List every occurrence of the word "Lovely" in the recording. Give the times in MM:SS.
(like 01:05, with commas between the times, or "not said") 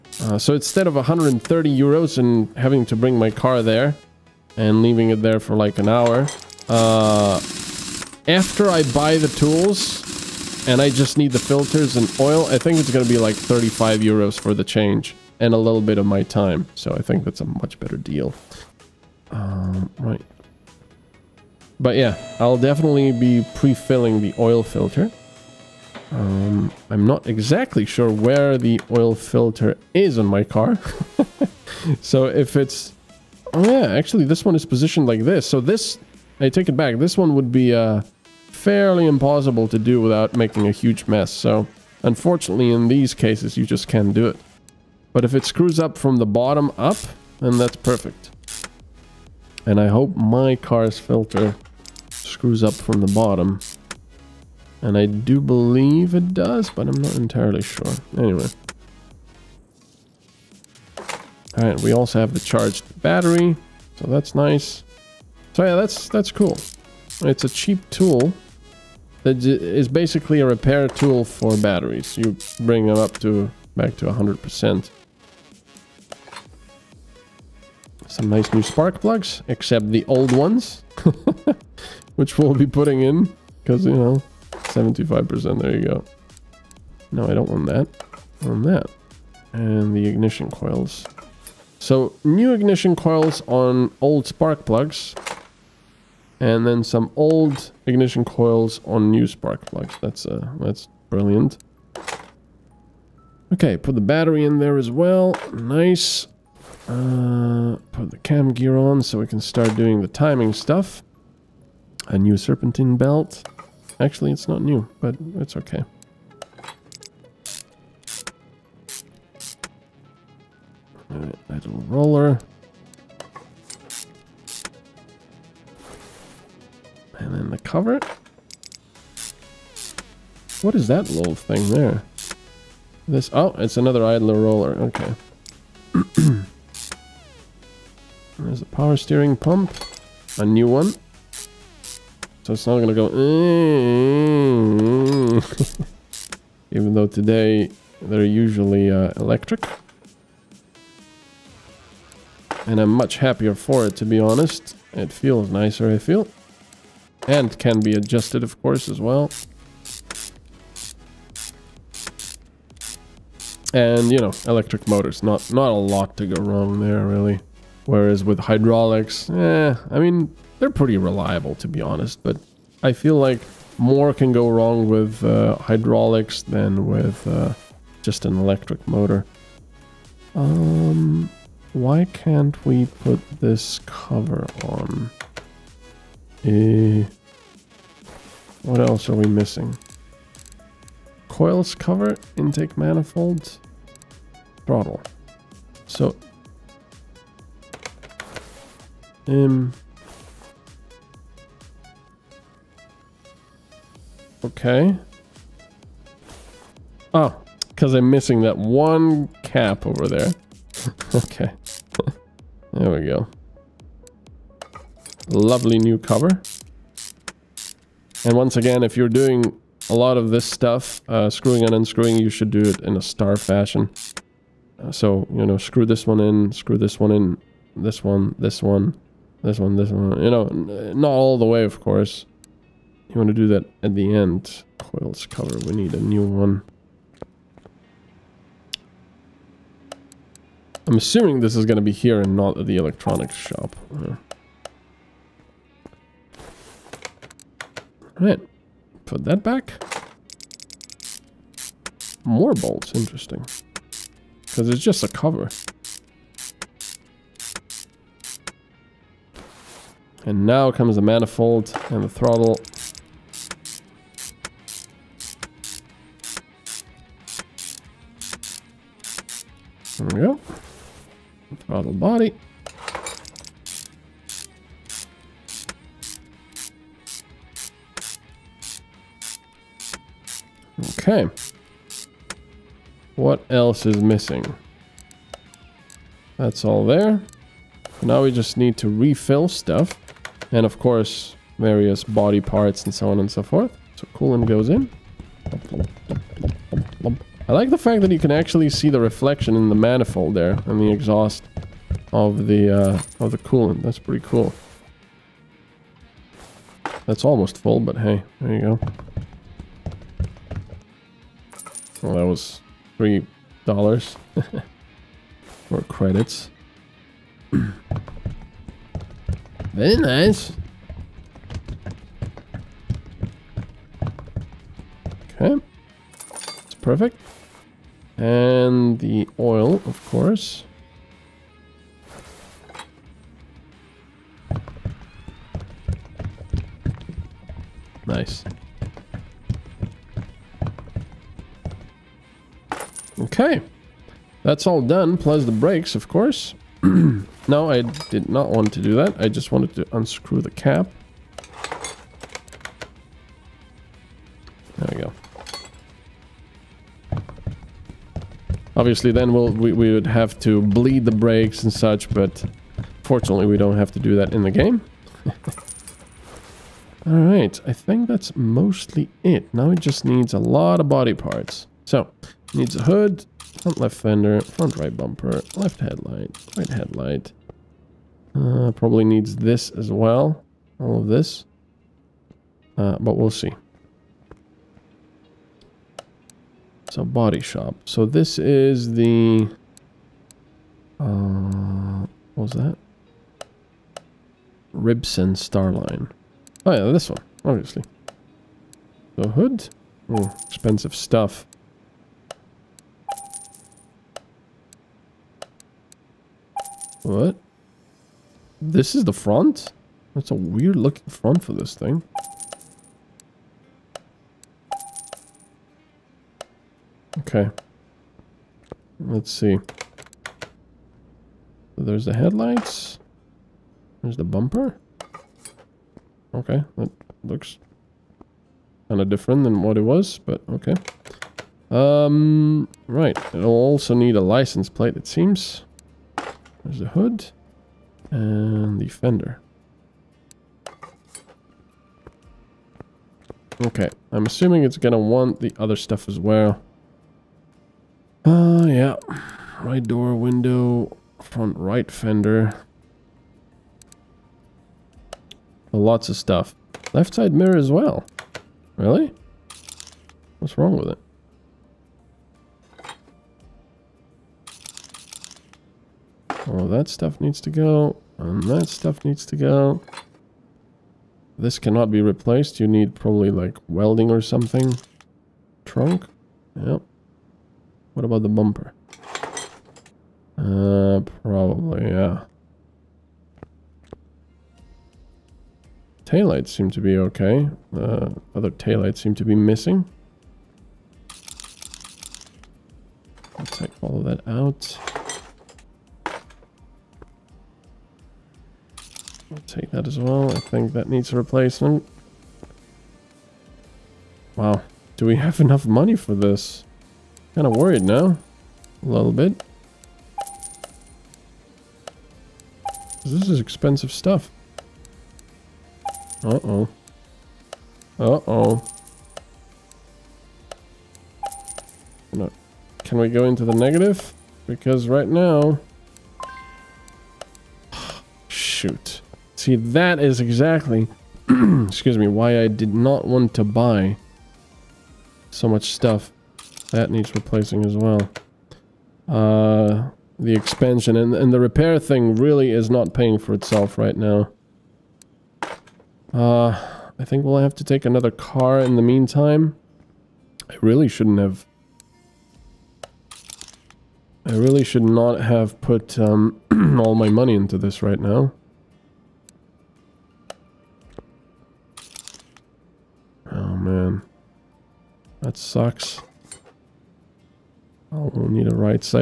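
03:35.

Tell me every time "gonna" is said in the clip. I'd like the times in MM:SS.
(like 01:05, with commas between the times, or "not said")
02:22, 07:24.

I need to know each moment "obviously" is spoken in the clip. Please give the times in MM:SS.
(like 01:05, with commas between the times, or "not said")
05:58, 06:37.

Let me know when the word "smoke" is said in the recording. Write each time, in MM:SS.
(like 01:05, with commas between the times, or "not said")
not said.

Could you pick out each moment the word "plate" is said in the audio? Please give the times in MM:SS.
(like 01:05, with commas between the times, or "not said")
07:14.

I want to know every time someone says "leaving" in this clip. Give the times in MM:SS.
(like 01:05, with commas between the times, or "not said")
00:04.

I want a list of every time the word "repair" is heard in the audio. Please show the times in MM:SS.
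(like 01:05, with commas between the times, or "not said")
01:10, 09:01.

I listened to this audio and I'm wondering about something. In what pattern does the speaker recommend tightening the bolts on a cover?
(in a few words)
star fashion.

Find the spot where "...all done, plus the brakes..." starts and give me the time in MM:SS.
05:44.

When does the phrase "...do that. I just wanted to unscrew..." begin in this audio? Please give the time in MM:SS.
05:48.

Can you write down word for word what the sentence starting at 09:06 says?
Uh, I think we'll have to take another car in the meantime.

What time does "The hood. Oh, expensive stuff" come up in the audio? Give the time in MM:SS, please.
06:39.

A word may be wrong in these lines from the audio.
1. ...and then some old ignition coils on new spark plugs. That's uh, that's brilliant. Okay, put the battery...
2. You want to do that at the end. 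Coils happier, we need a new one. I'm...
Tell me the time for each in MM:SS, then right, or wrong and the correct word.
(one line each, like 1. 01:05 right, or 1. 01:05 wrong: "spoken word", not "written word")
1. 01:36 right
2. 03:53 wrong: "cover", not "happier".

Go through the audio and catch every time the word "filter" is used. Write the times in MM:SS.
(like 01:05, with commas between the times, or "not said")
00:11, 00:24, 00:29, 00:50.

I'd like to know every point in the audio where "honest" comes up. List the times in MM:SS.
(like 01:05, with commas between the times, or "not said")
02:34, 02:51.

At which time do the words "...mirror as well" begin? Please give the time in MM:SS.
07:37.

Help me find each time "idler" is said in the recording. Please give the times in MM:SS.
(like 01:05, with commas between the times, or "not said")
02:14.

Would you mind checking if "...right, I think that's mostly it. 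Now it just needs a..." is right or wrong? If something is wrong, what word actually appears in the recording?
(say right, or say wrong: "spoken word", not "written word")
right.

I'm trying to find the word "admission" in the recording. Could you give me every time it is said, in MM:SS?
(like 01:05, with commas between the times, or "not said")
not said.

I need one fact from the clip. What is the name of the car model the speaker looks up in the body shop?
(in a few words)
Ribson Starline.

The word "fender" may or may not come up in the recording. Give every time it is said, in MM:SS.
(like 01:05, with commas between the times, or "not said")
06:13, 07:18, 07:31.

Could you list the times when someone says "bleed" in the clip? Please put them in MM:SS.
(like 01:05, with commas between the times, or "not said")
06:00.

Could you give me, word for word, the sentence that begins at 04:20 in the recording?
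And now comes the manifold and the throttle.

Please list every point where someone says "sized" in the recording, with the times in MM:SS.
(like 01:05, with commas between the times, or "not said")
not said.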